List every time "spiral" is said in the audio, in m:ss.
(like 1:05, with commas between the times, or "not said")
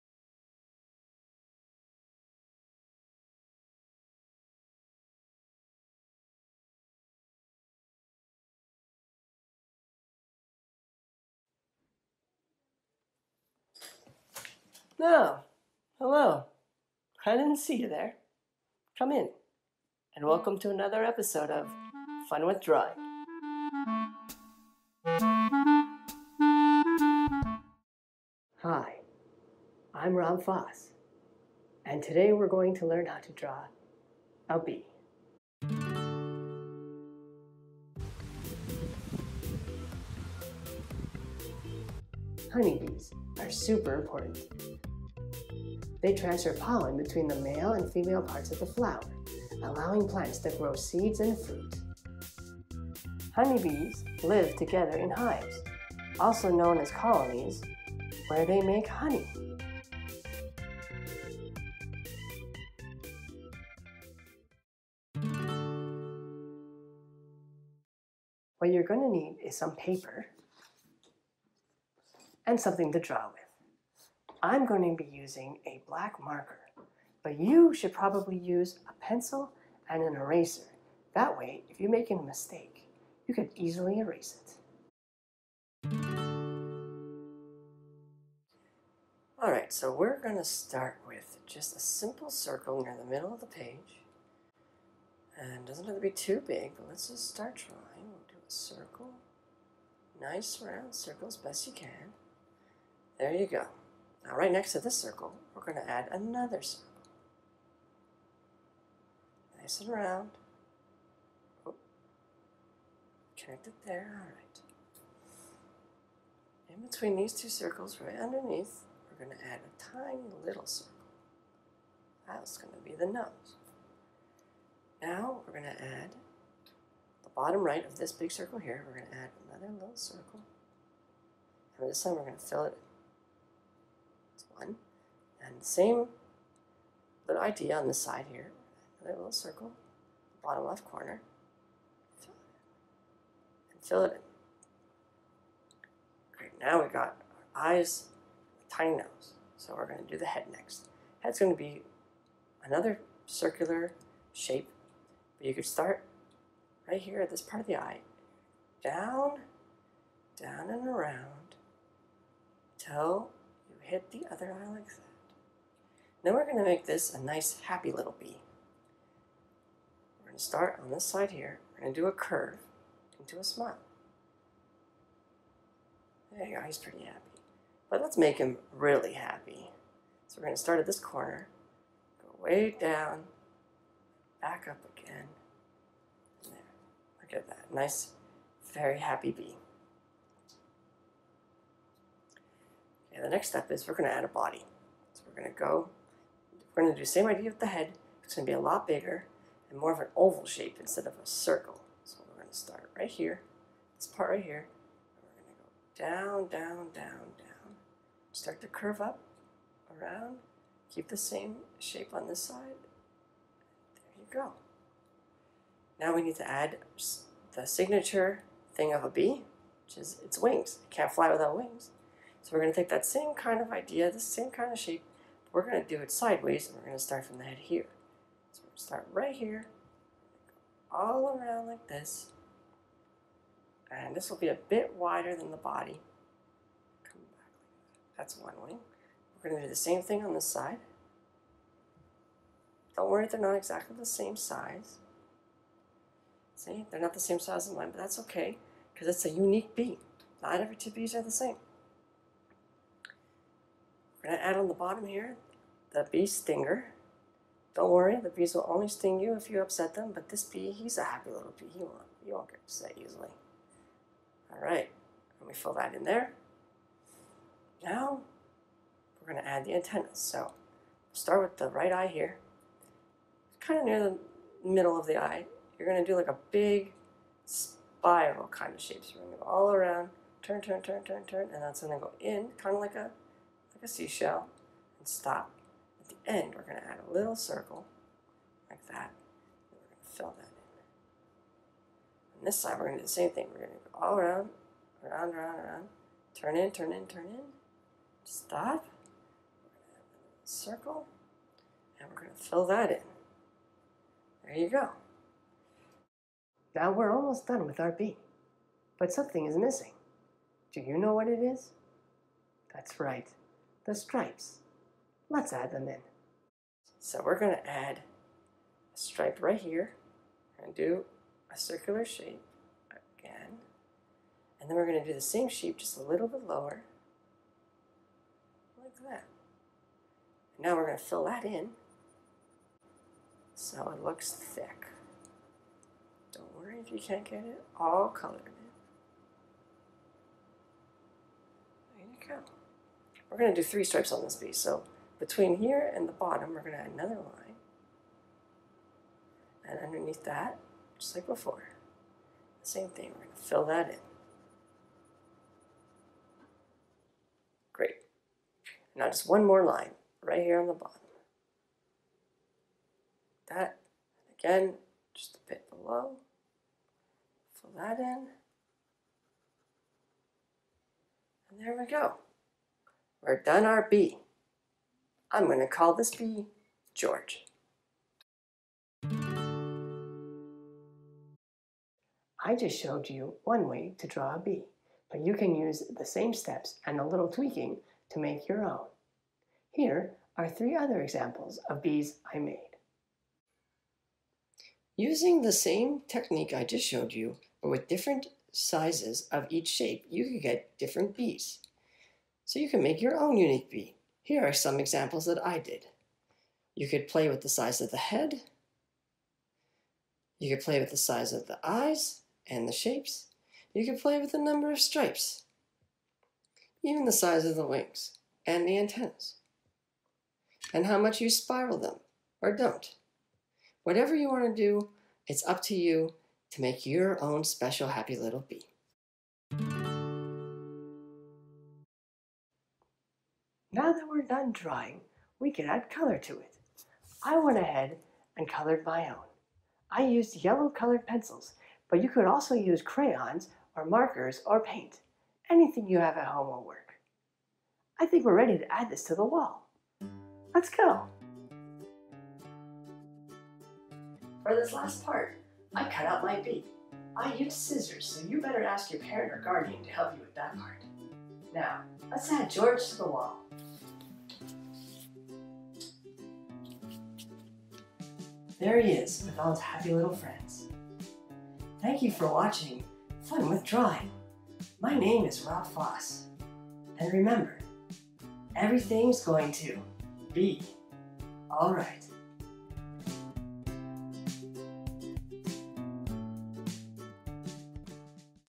4:37, 7:01.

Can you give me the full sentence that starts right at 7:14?
we're done drawing, we can add color to it.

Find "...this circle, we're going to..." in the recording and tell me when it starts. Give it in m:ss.
1:44.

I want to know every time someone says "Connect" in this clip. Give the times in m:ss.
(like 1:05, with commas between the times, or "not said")
1:53.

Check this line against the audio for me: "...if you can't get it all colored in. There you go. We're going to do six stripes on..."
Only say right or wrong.
wrong.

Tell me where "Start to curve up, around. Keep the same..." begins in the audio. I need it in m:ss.
3:28.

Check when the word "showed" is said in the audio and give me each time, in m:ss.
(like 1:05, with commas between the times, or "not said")
6:22, 6:36.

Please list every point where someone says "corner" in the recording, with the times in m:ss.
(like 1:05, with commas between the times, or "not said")
2:20, 3:00.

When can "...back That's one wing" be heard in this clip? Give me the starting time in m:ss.
3:57.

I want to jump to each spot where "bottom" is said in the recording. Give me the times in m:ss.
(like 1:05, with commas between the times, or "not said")
2:07, 2:20, 4:14, 5:46, 6:00.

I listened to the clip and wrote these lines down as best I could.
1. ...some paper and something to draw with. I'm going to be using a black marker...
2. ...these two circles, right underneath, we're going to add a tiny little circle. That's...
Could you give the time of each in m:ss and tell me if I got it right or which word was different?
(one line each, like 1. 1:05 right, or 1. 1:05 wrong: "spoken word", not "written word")
1. 1:09 right
2. 1:57 right.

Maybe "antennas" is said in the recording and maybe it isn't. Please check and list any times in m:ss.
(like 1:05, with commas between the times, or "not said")
4:29, 6:58.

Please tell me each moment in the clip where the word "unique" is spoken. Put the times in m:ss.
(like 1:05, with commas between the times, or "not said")
4:09, 6:43.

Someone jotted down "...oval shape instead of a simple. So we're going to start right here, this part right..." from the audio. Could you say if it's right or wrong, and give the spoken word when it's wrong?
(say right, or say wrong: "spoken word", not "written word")
wrong: "circle", not "simple".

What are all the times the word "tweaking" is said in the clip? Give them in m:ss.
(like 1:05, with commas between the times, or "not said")
6:27.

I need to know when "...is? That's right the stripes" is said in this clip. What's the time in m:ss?
5:11.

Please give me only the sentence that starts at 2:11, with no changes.
And this time we're going to fill it one.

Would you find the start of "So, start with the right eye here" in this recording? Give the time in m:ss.
4:30.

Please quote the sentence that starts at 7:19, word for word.
I used yellow colored pencils, but you could also use crayons or markers or paint, anything you have at home will work.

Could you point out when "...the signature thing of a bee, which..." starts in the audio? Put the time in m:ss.
3:37.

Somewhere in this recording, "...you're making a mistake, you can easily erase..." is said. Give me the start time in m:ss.
1:21.